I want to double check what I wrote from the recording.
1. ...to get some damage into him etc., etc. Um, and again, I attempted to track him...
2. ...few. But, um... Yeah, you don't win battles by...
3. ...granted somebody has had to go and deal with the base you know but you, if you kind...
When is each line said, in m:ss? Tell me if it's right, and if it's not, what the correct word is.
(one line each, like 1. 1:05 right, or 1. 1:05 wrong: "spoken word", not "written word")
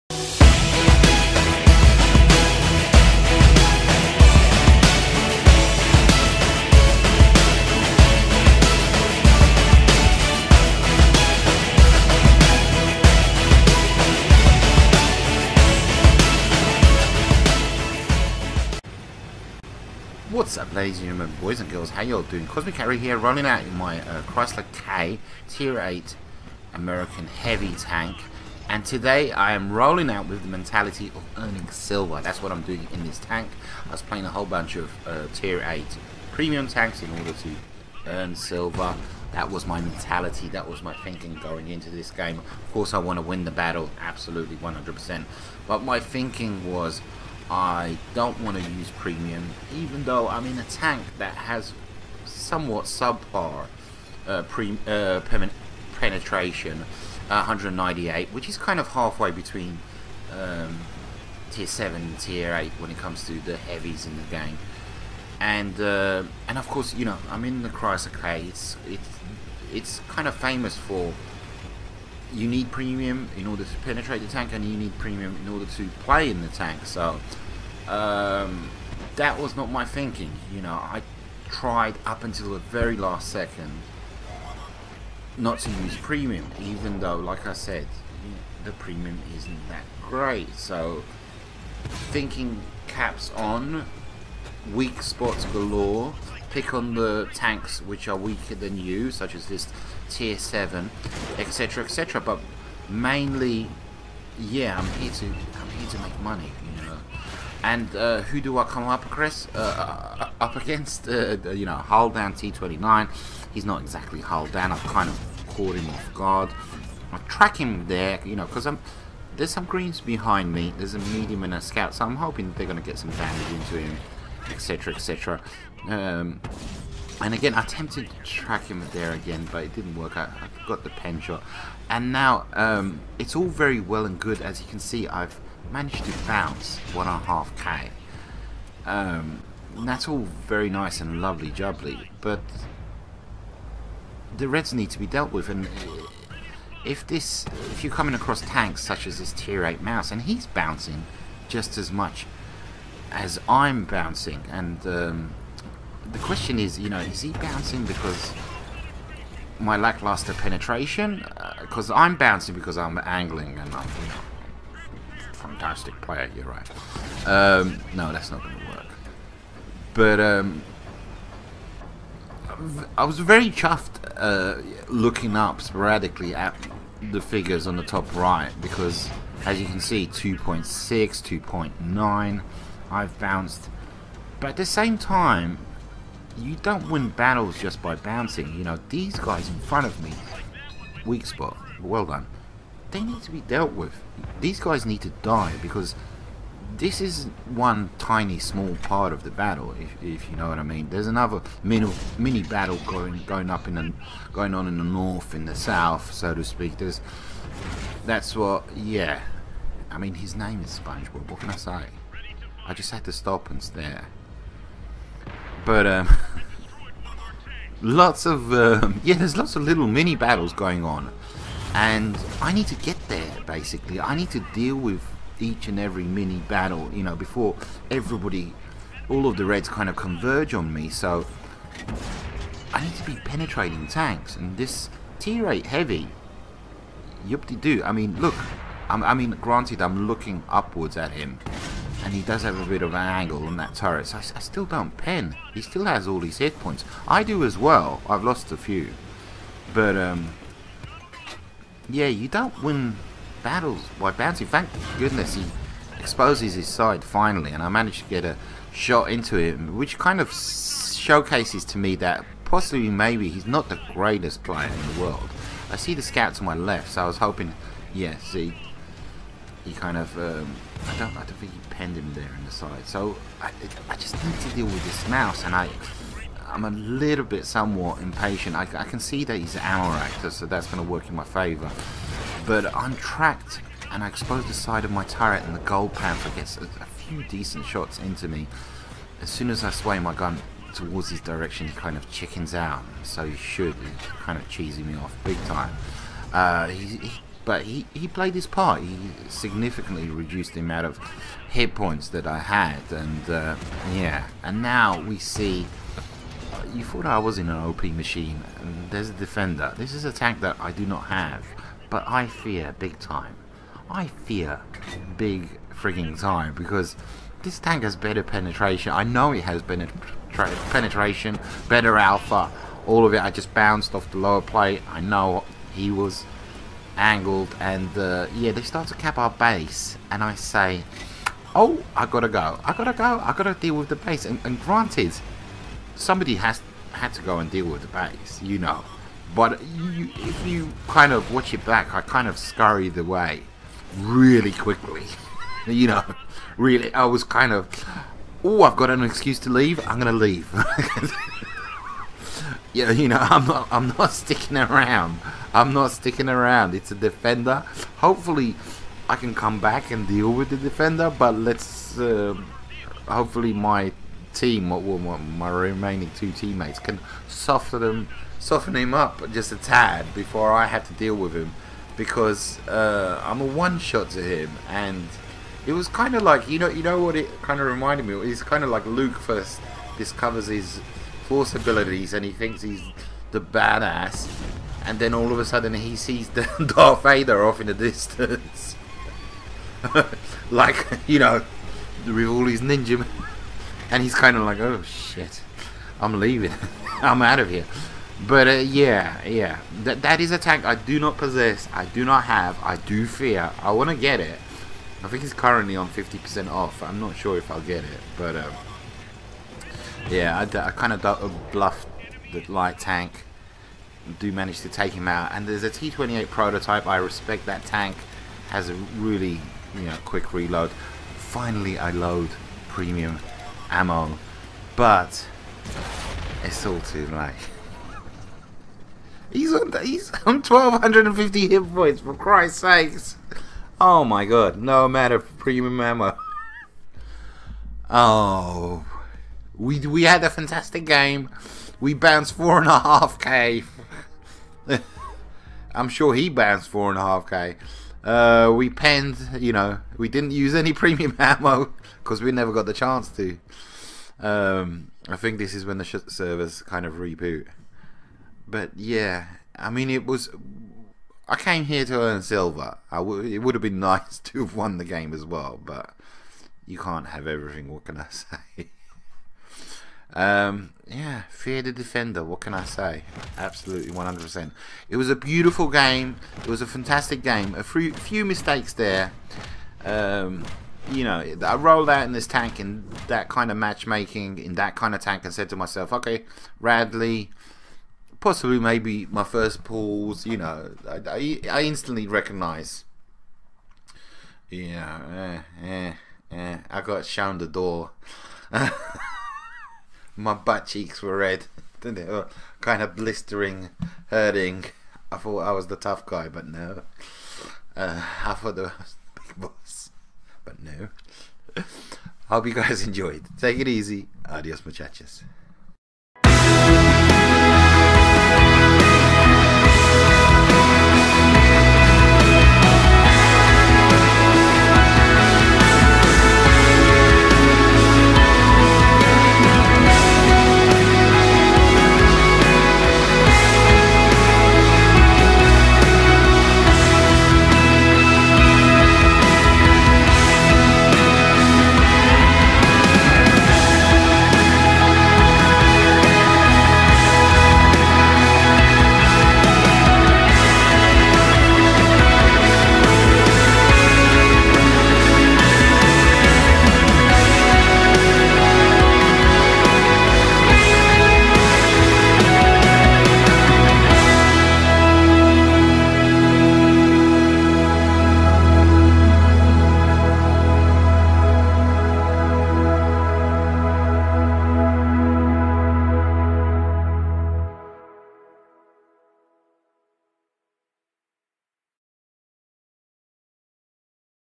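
1. 2:02 right
2. 4:08 right
3. 5:34 right.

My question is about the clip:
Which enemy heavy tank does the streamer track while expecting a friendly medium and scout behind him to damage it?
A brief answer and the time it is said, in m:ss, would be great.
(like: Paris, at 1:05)
T29, at 1:52.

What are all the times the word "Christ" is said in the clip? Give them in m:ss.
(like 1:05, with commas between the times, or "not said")
7:12.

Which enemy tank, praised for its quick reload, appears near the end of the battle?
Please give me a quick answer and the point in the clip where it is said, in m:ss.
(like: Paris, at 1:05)
T28 prototype, at 6:55.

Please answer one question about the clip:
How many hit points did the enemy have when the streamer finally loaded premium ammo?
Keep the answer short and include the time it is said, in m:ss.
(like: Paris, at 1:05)
1250, at 7:10.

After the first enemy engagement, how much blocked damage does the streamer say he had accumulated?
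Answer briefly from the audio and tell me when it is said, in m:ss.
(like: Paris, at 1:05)
1.5k, at 2:16.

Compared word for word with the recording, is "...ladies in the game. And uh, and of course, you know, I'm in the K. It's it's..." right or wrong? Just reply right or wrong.
wrong.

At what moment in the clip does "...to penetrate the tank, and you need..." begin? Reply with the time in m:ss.
1:13.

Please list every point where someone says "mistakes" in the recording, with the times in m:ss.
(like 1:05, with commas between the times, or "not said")
7:58.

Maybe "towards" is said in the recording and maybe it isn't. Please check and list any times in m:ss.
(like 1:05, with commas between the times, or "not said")
4:50.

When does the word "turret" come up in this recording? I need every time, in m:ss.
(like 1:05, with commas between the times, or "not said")
4:03, 4:45.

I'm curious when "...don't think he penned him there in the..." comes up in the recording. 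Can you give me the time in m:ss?
4:31.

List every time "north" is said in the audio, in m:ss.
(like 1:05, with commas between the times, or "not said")
3:24.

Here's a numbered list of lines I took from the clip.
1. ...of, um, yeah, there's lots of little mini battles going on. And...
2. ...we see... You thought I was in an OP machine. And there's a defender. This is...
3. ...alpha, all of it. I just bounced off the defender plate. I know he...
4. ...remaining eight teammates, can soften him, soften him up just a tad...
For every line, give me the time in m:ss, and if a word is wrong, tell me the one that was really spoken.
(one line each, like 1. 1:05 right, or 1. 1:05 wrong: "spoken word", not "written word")
1. 3:38 right
2. 5:05 right
3. 5:21 wrong: "lower", not "defender"
4. 6:05 wrong: "two", not "eight".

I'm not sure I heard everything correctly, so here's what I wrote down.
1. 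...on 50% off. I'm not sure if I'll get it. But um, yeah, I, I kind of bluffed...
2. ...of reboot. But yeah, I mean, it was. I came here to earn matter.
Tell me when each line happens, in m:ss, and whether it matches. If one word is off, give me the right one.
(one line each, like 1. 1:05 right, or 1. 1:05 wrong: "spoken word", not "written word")
1. 6:45 right
2. 7:36 wrong: "silver", not "matter".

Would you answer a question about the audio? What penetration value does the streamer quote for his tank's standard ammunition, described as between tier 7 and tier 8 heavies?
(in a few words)
198.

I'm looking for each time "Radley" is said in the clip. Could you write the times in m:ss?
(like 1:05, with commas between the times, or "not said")
8:06.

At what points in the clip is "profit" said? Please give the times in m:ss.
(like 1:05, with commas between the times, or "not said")
not said.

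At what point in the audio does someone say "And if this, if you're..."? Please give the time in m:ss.
2:25.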